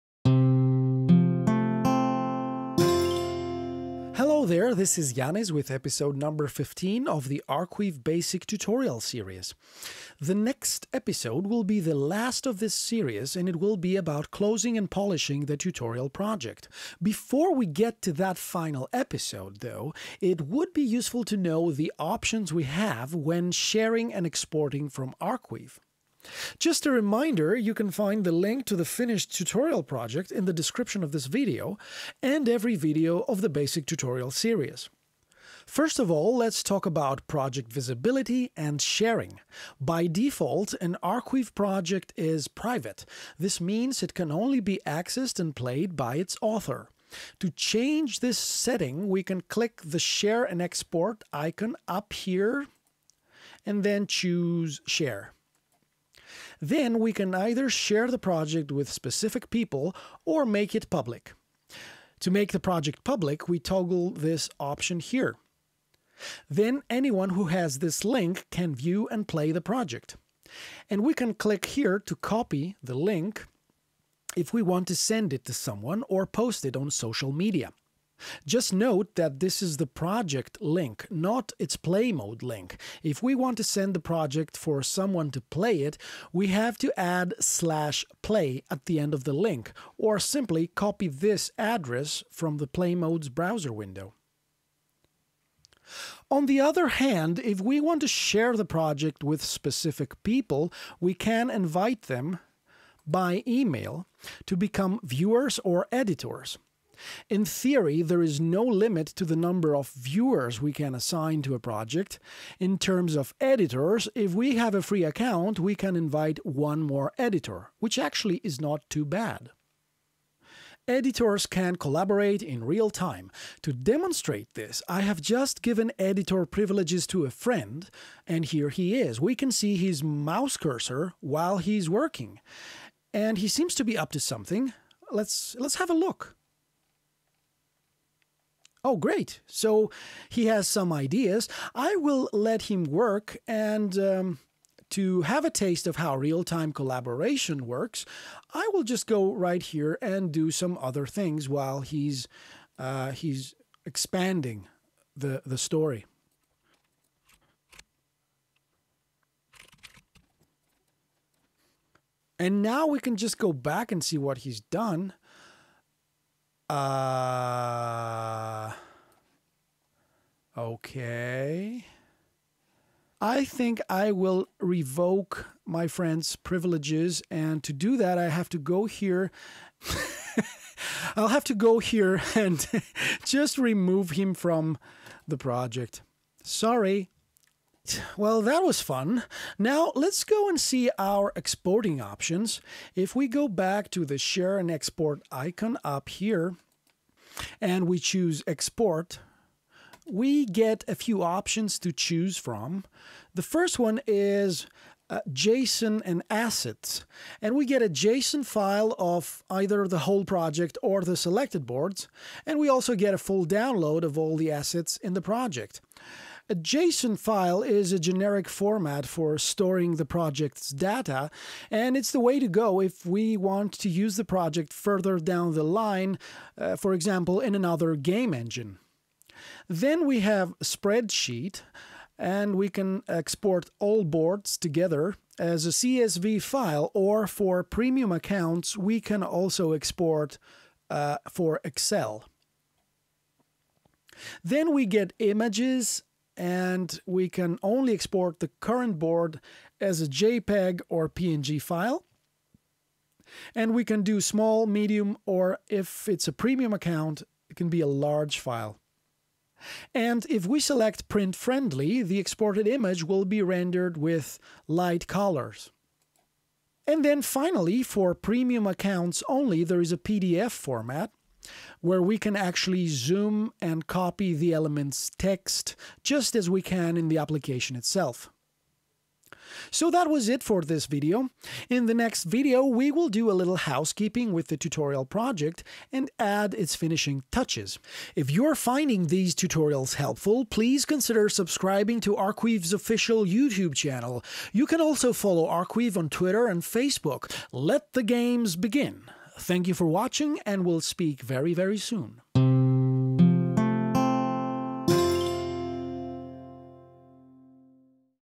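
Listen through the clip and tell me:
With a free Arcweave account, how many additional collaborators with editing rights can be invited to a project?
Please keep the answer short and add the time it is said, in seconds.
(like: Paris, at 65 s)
1, at 116 s.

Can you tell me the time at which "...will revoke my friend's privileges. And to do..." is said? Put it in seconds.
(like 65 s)
174 s.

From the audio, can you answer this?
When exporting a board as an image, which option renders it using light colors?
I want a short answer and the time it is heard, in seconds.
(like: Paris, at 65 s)
Print friendly, at 261 s.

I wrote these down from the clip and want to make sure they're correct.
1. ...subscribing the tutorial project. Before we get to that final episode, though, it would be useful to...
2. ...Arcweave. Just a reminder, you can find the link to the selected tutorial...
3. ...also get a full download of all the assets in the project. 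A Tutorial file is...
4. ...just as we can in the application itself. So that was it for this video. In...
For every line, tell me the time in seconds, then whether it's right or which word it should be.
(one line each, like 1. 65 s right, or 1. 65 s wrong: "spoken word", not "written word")
1. 14 s wrong: "polishing", not "subscribing"
2. 25 s wrong: "finished", not "selected"
3. 212 s wrong: "JSON", not "Tutorial"
4. 276 s right.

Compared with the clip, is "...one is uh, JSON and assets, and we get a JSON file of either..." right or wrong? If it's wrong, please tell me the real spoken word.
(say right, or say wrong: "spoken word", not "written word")
right.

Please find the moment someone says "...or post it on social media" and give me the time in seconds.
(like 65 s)
76 s.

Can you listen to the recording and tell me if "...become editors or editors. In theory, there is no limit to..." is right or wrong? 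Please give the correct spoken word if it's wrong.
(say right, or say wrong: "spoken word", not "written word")
wrong: "viewers", not "editors".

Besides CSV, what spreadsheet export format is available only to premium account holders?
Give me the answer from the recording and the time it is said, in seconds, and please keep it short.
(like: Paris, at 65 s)
Excel, at 241 s.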